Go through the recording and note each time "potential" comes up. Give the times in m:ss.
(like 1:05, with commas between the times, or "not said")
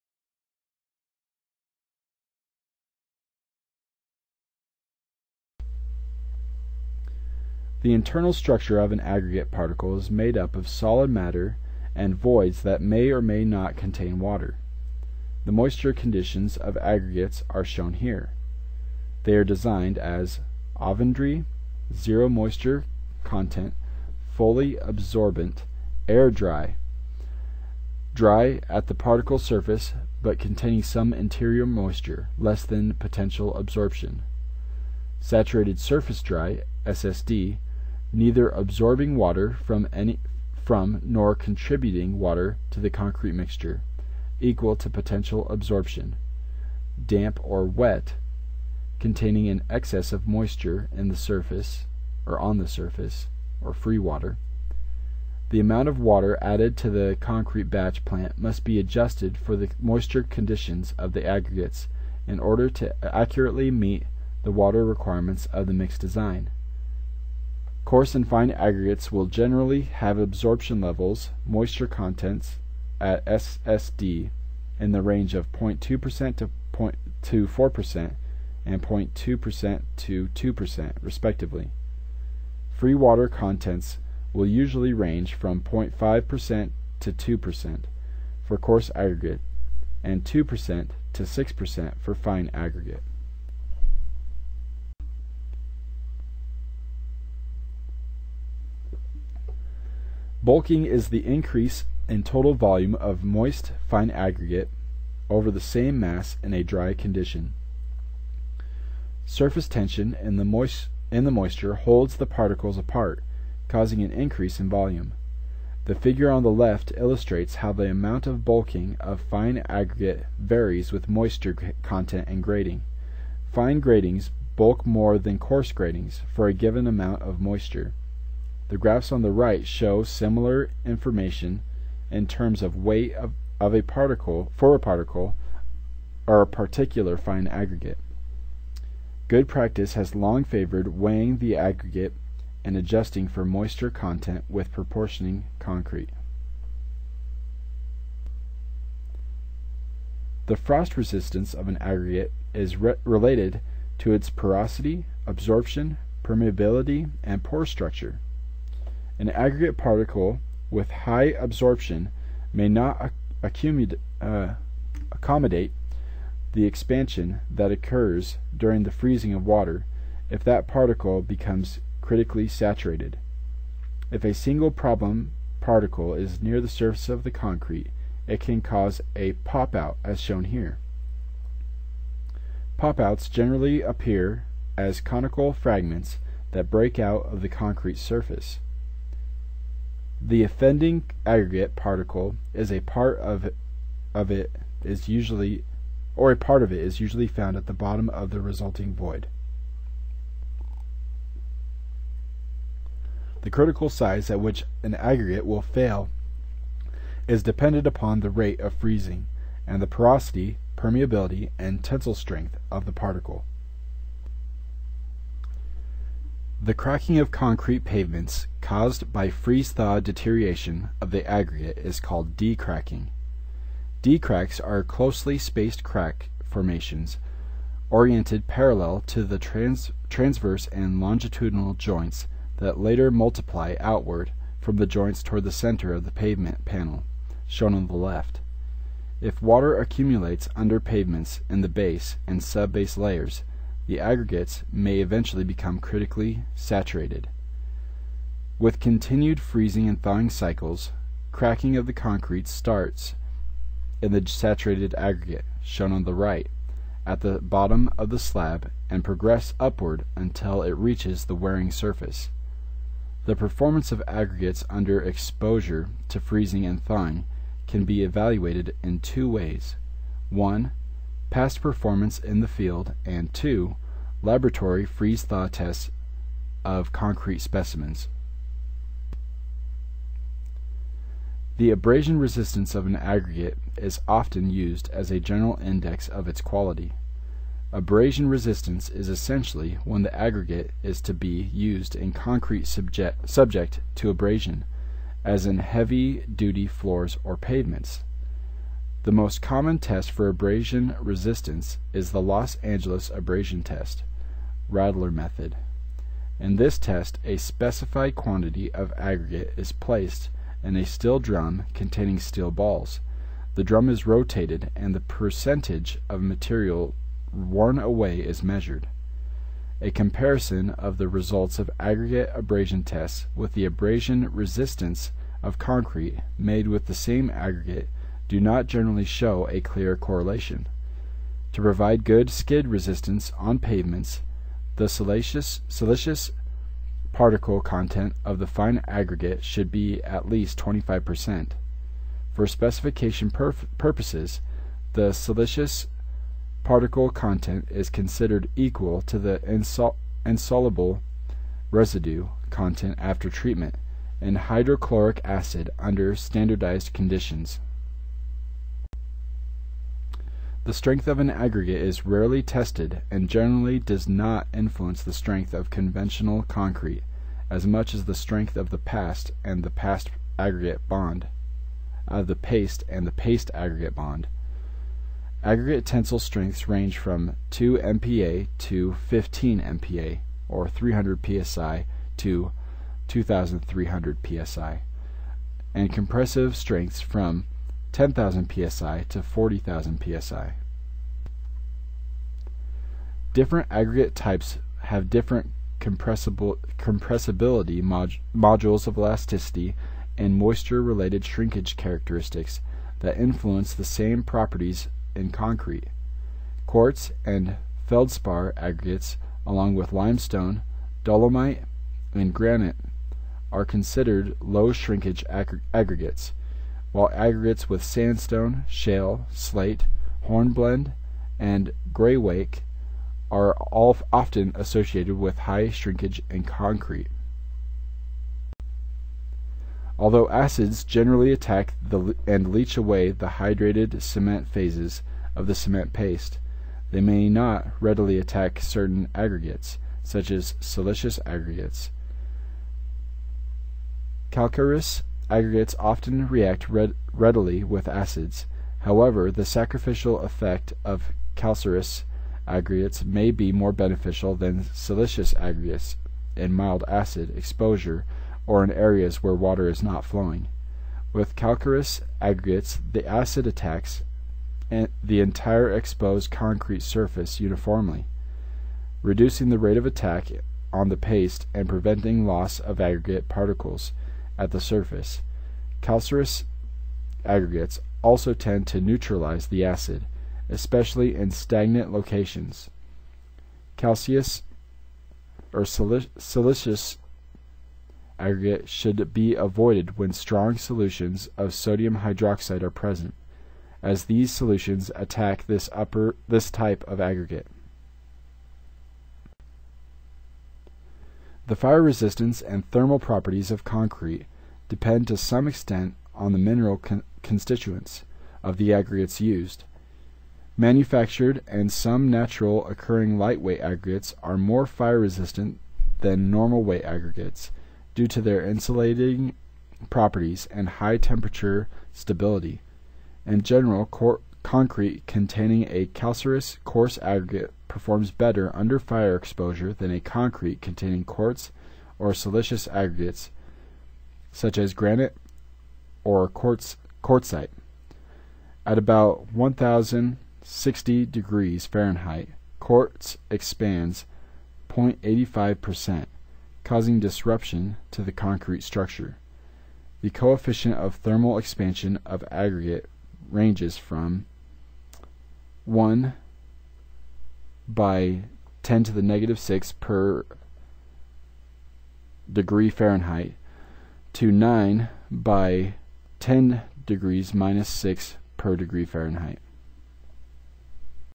0:32, 0:44.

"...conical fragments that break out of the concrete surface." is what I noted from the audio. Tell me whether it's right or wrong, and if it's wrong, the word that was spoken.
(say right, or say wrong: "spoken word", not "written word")
right.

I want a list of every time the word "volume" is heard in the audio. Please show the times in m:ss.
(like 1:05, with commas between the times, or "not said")
1:42, 1:54.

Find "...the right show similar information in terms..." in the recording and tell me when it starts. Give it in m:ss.
2:09.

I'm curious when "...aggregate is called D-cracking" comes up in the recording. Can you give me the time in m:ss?
3:41.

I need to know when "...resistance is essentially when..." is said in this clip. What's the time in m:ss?
4:48.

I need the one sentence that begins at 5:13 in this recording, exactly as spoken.
The drum is rotated and the percentage of material worn away is measured.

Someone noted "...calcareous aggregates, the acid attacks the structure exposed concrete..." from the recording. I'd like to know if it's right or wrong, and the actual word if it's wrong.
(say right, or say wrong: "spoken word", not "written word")
wrong: "entire", not "structure".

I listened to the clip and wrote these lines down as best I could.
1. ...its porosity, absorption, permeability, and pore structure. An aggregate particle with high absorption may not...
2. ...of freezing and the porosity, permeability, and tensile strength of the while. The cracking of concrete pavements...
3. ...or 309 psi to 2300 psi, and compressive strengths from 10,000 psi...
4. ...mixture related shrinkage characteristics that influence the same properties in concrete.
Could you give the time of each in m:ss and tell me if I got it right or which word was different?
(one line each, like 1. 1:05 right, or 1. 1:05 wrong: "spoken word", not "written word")
1. 2:34 right
2. 3:28 wrong: "particle", not "while"
3. 6:20 wrong: "300", not "309"
4. 6:40 wrong: "moisture", not "mixture".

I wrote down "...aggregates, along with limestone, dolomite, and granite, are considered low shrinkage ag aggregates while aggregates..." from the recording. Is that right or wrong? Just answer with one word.
right.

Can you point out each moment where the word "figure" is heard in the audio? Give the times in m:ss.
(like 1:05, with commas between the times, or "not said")
1:55.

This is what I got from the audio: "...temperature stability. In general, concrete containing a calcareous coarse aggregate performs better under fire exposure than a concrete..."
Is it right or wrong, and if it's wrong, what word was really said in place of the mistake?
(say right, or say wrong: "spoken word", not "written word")
right.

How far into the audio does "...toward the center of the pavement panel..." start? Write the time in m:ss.
3:55.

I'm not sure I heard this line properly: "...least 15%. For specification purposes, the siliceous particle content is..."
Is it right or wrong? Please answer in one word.
wrong.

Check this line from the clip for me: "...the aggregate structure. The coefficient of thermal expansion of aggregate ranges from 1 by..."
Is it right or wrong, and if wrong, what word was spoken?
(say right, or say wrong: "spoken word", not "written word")
wrong: "concrete", not "aggregate".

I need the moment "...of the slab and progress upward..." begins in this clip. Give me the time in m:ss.
4:17.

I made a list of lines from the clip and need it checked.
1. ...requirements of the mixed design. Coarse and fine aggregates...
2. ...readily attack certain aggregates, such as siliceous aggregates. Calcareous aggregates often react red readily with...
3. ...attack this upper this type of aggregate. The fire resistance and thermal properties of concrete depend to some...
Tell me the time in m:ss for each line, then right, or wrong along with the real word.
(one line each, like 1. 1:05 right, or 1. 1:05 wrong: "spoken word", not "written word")
1. 1:04 right
2. 7:17 right
3. 8:14 right.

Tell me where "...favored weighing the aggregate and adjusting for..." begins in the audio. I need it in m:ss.
2:20.